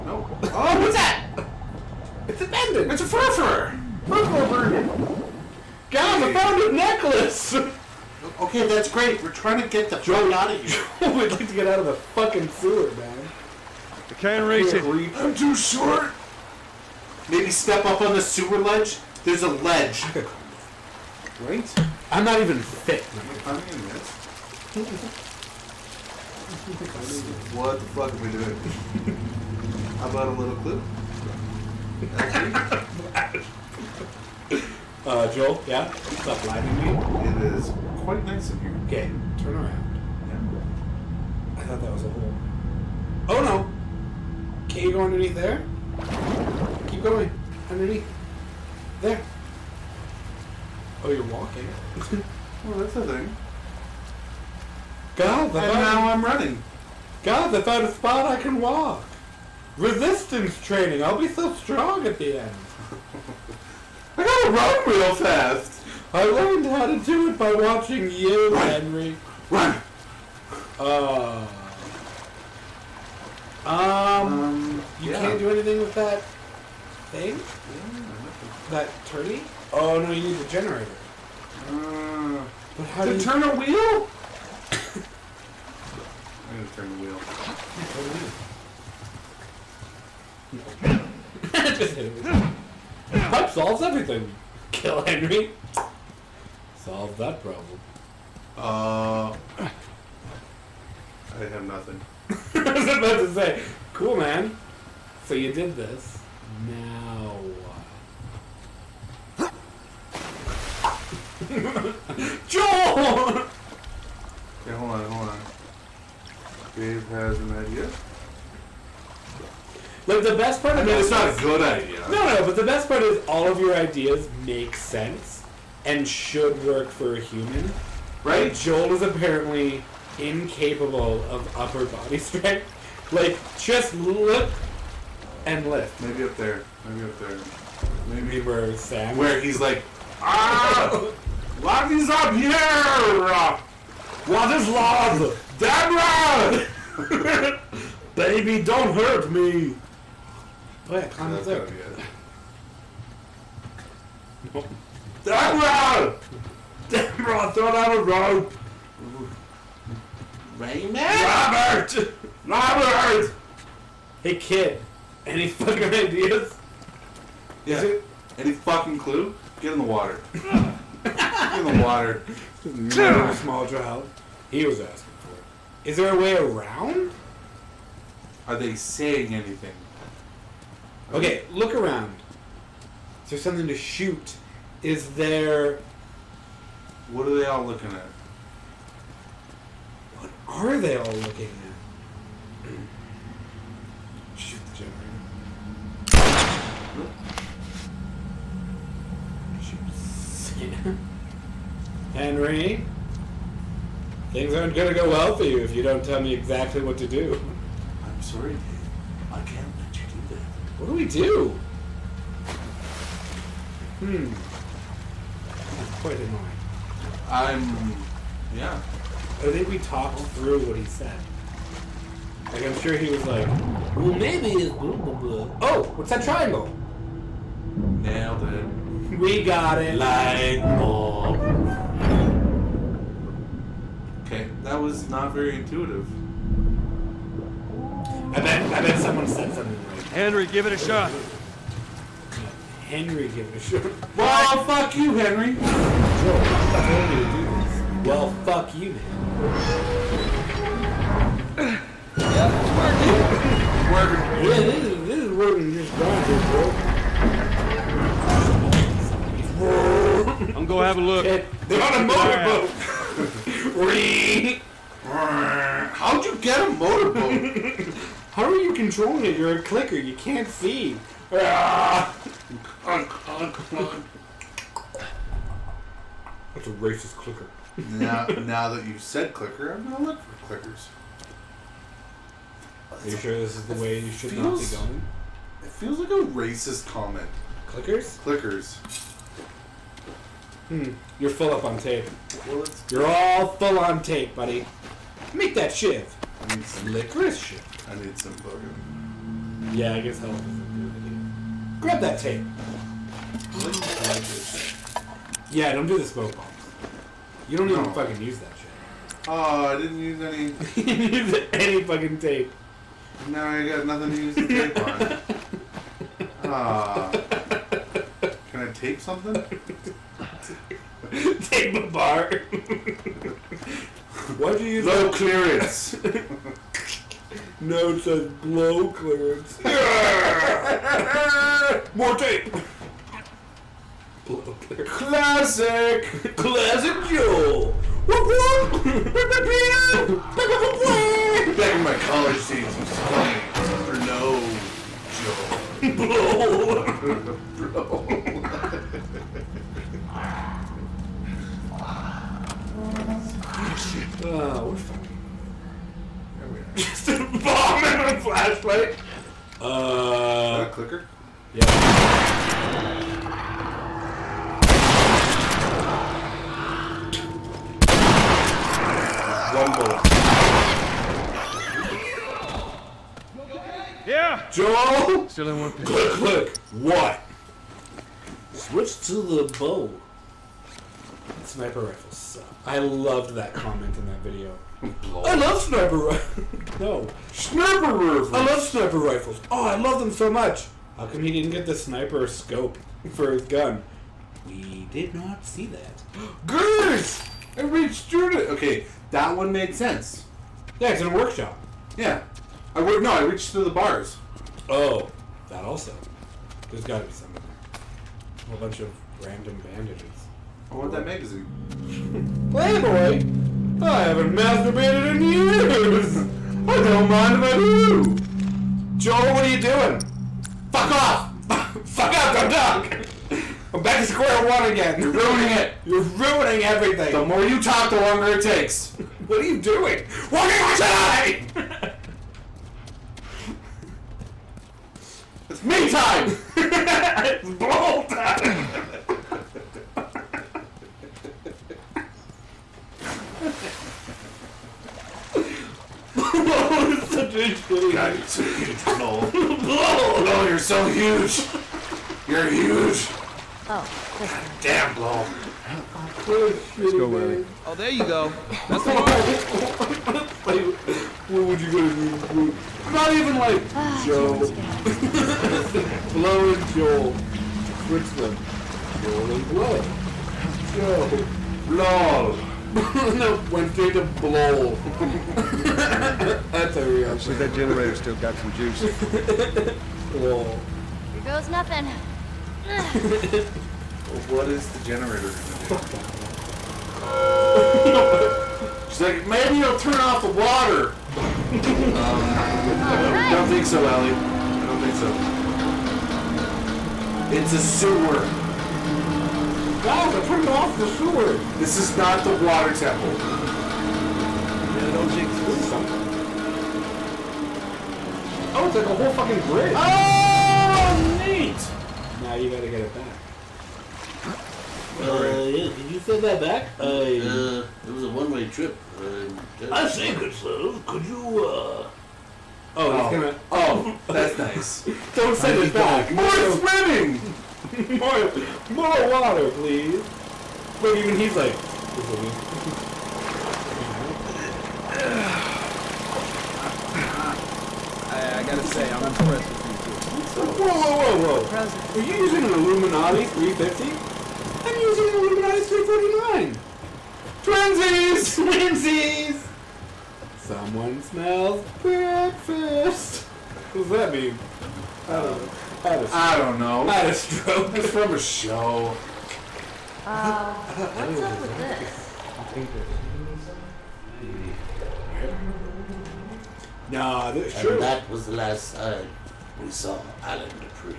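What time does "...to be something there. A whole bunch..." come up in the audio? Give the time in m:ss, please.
6:46.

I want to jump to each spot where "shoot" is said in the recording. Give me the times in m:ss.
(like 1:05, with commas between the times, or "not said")
3:03, 3:14.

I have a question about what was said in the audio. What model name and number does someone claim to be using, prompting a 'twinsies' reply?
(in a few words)
Illuminati 350.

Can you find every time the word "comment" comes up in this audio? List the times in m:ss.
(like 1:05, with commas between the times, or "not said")
4:46, 6:23.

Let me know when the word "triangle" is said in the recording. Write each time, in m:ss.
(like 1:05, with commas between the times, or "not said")
3:46.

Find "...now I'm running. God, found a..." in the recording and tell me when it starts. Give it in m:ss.
0:55.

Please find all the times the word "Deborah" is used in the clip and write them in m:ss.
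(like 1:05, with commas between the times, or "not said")
2:25, 2:35.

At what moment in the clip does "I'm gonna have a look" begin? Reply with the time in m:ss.
4:20.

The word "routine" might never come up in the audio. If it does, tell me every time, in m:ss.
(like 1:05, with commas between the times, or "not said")
not said.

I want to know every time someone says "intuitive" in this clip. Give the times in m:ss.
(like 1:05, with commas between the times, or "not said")
3:55.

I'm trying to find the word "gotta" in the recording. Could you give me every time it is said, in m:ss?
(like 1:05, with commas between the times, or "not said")
1:04, 8:32, 8:58.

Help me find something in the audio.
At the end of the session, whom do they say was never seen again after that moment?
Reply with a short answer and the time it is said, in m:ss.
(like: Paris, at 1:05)
Alan Dupree, at 9:30.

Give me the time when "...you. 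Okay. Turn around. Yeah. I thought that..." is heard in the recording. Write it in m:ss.
0:38.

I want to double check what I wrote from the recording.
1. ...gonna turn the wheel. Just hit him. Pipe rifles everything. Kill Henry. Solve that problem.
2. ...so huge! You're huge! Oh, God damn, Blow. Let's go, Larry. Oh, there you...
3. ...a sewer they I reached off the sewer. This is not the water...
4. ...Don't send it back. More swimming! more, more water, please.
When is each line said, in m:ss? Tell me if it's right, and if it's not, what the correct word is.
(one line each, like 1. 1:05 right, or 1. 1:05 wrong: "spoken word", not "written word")
1. 1:26 wrong: "solves", not "rifles"
2. 7:30 right
3. 8:17 wrong: "turned", not "reached"
4. 8:45 right.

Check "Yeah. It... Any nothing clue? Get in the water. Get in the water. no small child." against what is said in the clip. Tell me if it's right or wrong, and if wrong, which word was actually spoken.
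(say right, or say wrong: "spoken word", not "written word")
wrong: "fucking", not "nothing".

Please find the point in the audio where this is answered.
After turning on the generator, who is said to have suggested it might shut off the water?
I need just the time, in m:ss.
8:13.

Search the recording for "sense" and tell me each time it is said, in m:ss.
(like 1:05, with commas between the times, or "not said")
2:04, 6:39.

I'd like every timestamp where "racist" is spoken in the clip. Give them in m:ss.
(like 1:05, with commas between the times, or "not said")
4:36, 4:46.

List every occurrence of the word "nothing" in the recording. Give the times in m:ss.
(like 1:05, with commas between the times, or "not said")
1:41, 5:13, 8:01.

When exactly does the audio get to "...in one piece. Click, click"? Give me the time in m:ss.
6:15.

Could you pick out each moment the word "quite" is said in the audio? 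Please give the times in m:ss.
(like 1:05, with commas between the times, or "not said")
0:38, 3:36.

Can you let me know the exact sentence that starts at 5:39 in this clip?
Back in my college days, I was playing for no Joel.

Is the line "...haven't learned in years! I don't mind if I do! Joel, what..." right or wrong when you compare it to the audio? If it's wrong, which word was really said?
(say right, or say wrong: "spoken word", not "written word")
wrong: "masturbated", not "learned".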